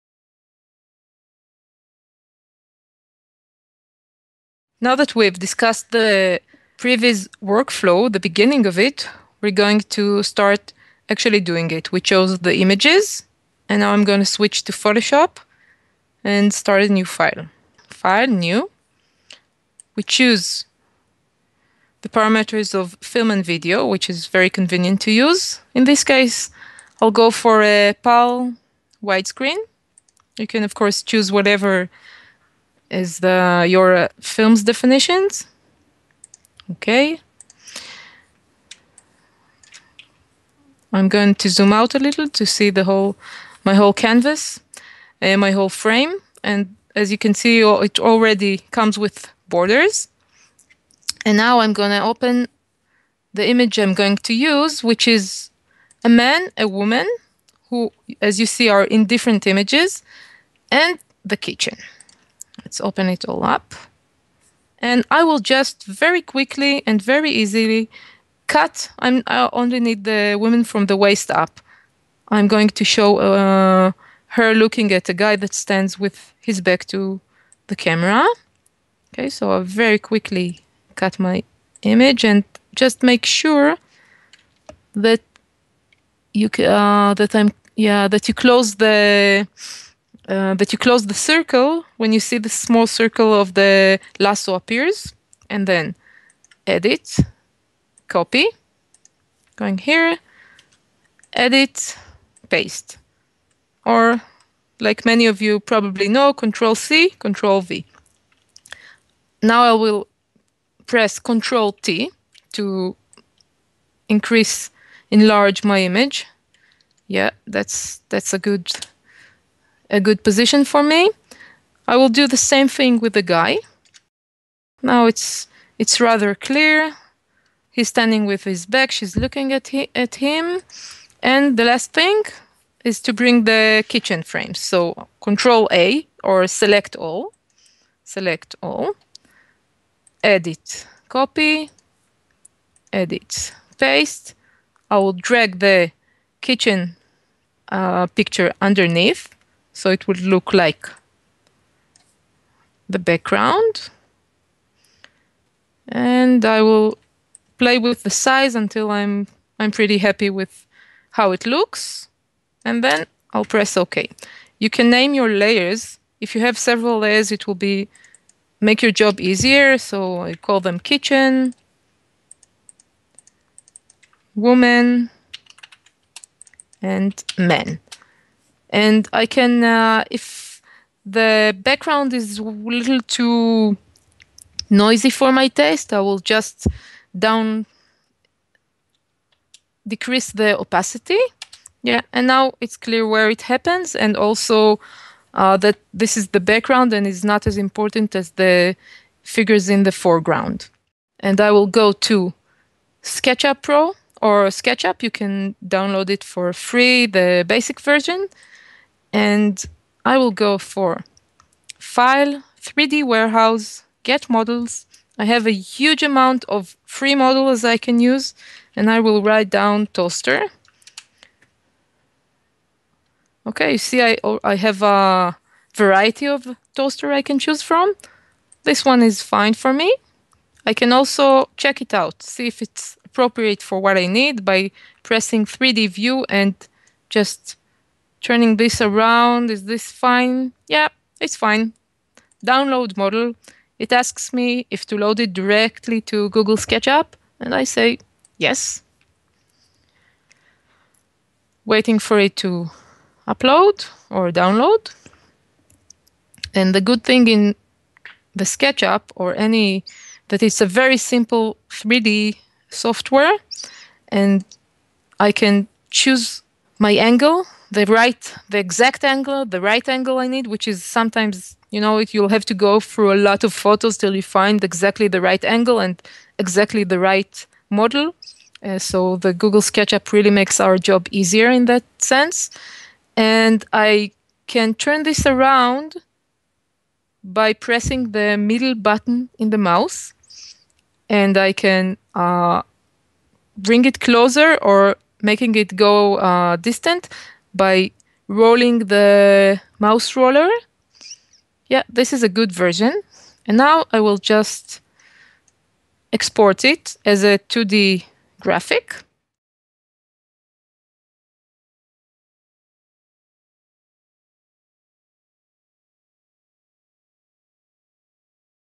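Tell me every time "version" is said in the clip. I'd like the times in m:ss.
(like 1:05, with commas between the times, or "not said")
3:27, 5:02.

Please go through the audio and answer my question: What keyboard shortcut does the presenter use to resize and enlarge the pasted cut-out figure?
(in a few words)
Control T.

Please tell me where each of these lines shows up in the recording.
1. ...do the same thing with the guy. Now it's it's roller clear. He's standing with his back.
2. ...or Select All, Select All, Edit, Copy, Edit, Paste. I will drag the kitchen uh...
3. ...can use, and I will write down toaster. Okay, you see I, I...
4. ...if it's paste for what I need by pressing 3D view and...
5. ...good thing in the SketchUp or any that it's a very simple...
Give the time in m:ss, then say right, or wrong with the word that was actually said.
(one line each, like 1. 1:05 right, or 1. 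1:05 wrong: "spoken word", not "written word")
1. 2:02 wrong: "rather", not "roller"
2. 2:16 right
3. 3:37 right
4. 3:52 wrong: "appropriate", not "paste"
5. 4:16 right.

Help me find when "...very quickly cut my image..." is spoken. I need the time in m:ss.
1:19.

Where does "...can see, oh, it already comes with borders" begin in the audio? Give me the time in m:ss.
0:47.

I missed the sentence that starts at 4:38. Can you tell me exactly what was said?
Uh, so the Google SketchUp really makes our job easier in that sense.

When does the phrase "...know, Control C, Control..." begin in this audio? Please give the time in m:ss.
1:46.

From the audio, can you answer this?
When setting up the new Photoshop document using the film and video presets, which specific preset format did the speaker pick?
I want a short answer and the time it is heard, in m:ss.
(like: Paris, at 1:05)
PAL widescreen, at 0:28.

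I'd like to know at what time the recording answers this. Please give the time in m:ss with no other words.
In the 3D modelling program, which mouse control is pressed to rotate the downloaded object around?
4:48.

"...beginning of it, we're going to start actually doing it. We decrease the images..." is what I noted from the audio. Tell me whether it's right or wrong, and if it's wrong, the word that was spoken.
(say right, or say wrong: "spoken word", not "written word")
wrong: "chose", not "decrease".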